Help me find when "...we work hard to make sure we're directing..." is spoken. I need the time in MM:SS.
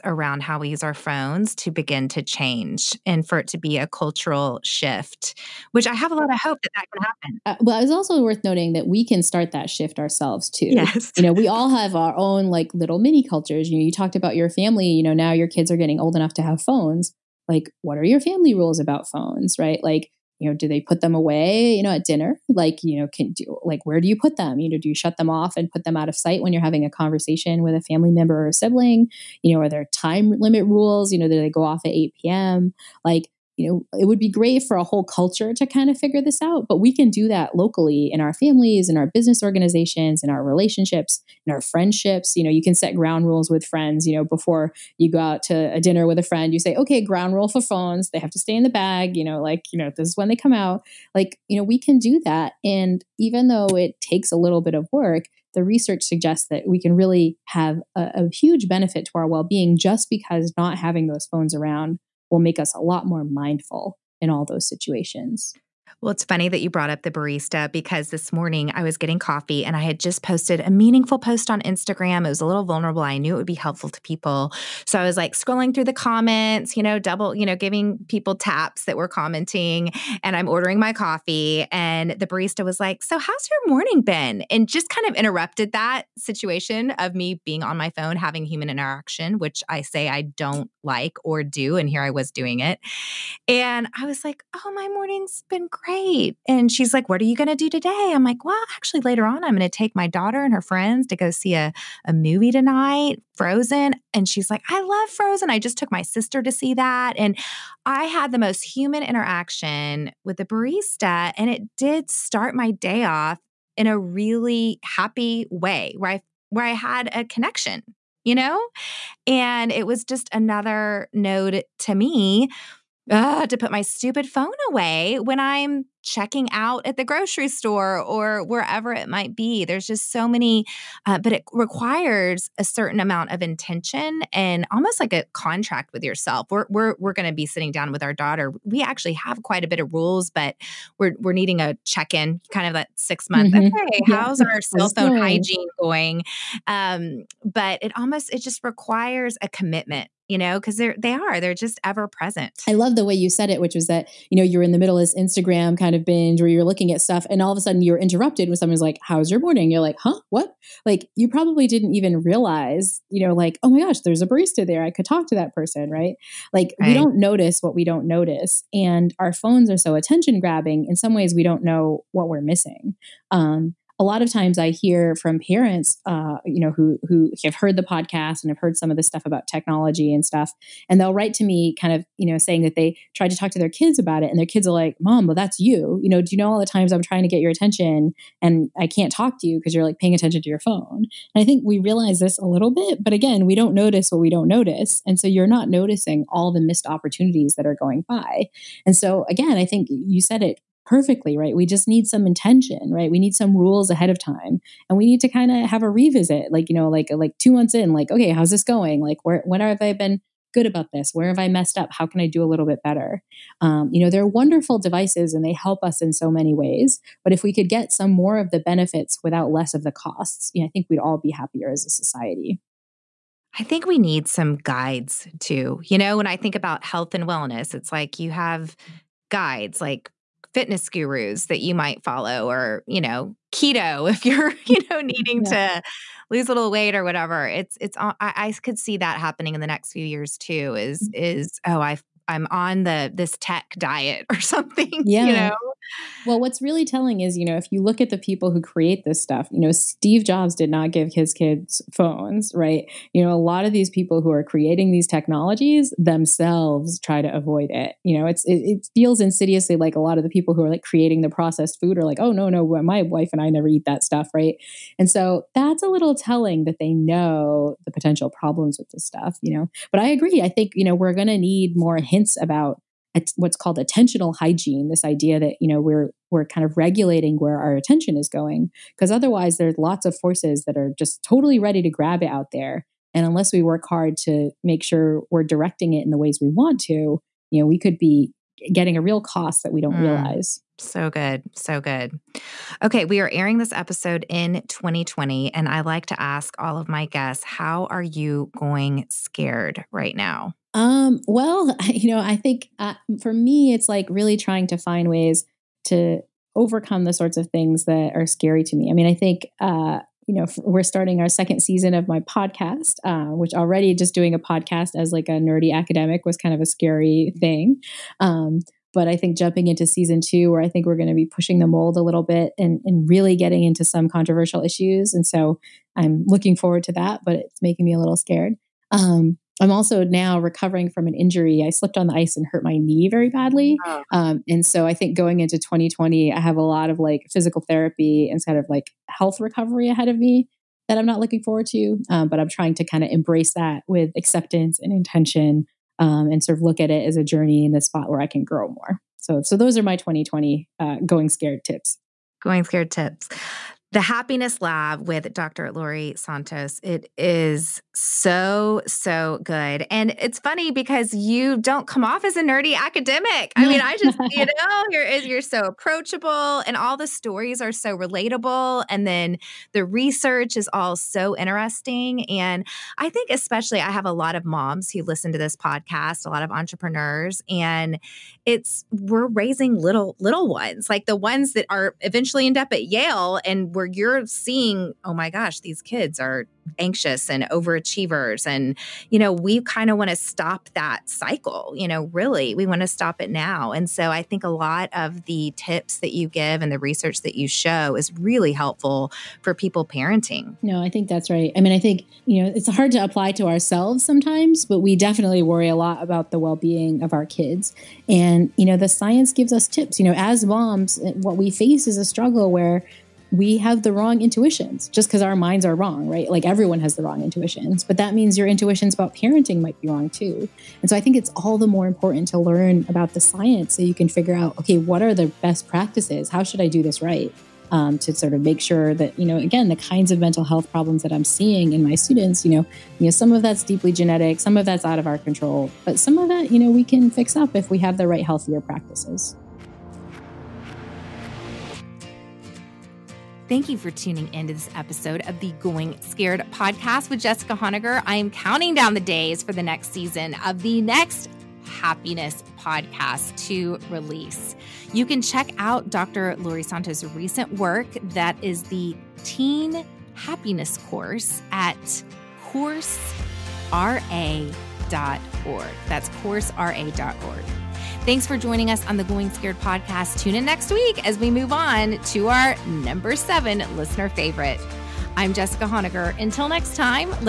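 04:43.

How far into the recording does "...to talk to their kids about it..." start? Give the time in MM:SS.
03:03.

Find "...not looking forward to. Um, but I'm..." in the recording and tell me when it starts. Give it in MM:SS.
05:41.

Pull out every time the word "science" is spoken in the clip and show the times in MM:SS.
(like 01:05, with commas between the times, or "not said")
06:48, 07:03.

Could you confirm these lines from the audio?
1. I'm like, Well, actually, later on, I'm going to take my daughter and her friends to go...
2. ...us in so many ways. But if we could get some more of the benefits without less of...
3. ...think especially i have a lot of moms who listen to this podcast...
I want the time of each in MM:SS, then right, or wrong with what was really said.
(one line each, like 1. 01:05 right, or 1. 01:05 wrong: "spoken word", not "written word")
1. 01:38 right
2. 03:35 right
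3. 06:13 right.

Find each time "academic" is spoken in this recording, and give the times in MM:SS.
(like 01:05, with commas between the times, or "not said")
05:15, 06:02.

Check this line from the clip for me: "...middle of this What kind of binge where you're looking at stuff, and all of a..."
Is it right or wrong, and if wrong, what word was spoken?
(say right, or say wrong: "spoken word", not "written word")
wrong: "Instagram", not "What".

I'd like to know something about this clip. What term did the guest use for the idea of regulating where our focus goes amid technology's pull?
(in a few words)
attentional hygiene.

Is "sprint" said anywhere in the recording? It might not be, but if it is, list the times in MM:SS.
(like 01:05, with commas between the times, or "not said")
not said.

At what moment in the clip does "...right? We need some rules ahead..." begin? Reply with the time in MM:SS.
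03:22.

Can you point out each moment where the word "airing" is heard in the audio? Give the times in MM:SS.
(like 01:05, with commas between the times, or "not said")
04:53.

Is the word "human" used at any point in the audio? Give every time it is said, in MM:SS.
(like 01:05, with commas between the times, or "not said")
01:28, 01:48.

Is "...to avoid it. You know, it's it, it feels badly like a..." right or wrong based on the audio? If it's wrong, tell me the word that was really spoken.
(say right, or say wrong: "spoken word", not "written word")
wrong: "insidiously", not "badly".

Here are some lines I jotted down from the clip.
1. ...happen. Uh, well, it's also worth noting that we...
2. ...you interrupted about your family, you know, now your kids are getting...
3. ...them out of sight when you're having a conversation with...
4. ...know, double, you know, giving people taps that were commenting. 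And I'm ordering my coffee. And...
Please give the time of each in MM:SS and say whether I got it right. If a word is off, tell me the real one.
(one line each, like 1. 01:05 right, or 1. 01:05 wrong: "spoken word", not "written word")
1. 00:07 right
2. 00:13 wrong: "talked", not "interrupted"
3. 00:25 right
4. 01:16 right.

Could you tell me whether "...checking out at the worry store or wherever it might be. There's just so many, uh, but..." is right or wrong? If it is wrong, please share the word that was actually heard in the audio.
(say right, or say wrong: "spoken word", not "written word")
wrong: "grocery", not "worry".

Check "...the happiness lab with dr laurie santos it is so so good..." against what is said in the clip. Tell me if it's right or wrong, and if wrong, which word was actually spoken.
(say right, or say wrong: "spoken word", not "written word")
right.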